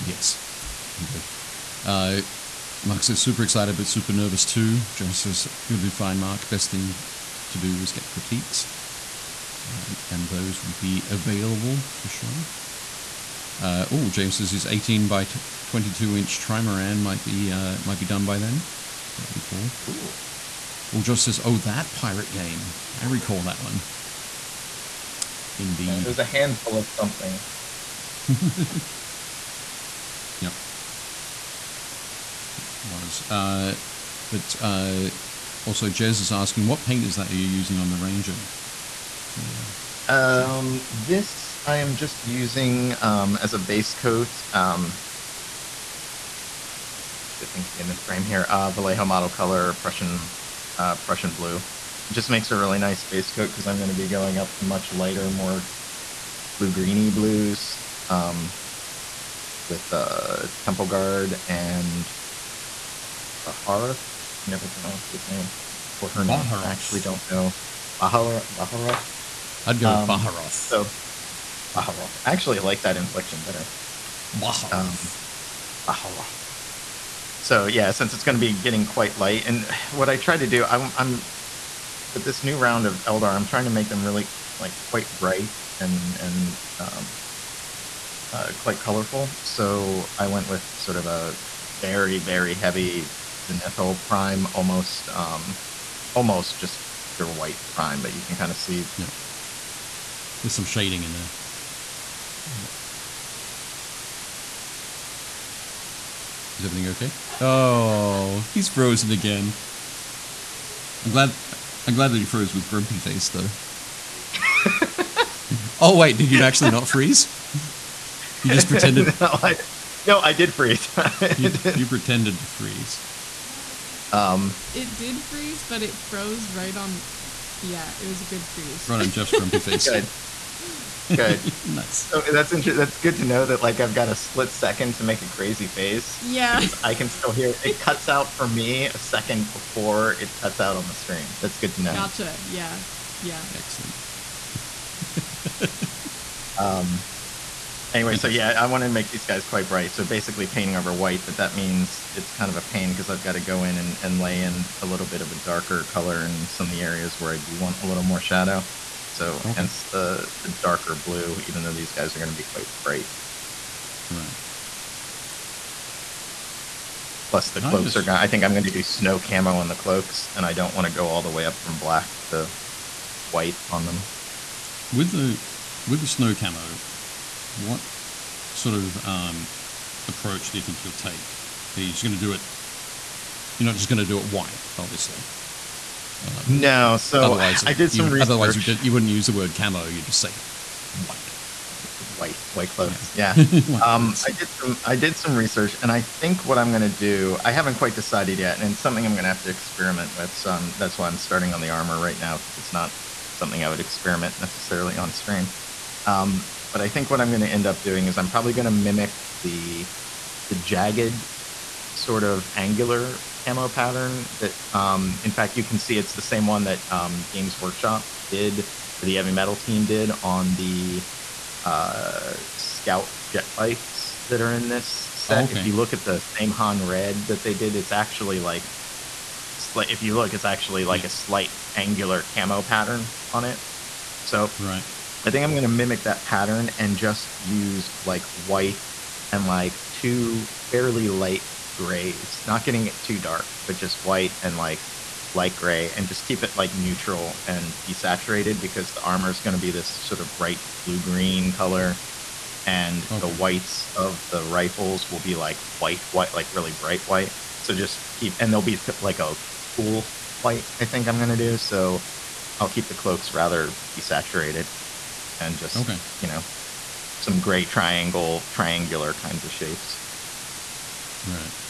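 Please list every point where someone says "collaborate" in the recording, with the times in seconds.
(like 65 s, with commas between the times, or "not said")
not said.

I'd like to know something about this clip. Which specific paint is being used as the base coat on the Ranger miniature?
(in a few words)
Prussian Blue.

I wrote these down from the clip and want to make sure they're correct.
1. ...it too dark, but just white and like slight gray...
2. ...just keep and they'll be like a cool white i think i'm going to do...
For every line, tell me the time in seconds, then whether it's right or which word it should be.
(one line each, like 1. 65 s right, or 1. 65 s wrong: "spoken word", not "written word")
1. 242 s wrong: "light", not "slight"
2. 257 s right.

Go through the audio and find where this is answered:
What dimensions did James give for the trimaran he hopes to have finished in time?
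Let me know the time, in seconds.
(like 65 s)
14 s.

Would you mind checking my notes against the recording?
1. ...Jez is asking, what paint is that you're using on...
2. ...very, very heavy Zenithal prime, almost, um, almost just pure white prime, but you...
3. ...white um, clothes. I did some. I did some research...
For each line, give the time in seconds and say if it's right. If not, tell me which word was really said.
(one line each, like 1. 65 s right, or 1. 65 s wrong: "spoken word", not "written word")
1. 35 s right
2. 91 s right
3. 193 s right.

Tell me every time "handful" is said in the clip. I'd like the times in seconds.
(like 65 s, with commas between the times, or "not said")
26 s.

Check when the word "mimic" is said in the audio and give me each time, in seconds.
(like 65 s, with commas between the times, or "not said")
208 s, 235 s.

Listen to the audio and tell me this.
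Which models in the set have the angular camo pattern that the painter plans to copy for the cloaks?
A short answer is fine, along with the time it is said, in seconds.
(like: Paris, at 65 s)
scout jet bikes, at 222 s.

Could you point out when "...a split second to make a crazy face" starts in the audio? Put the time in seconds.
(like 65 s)
134 s.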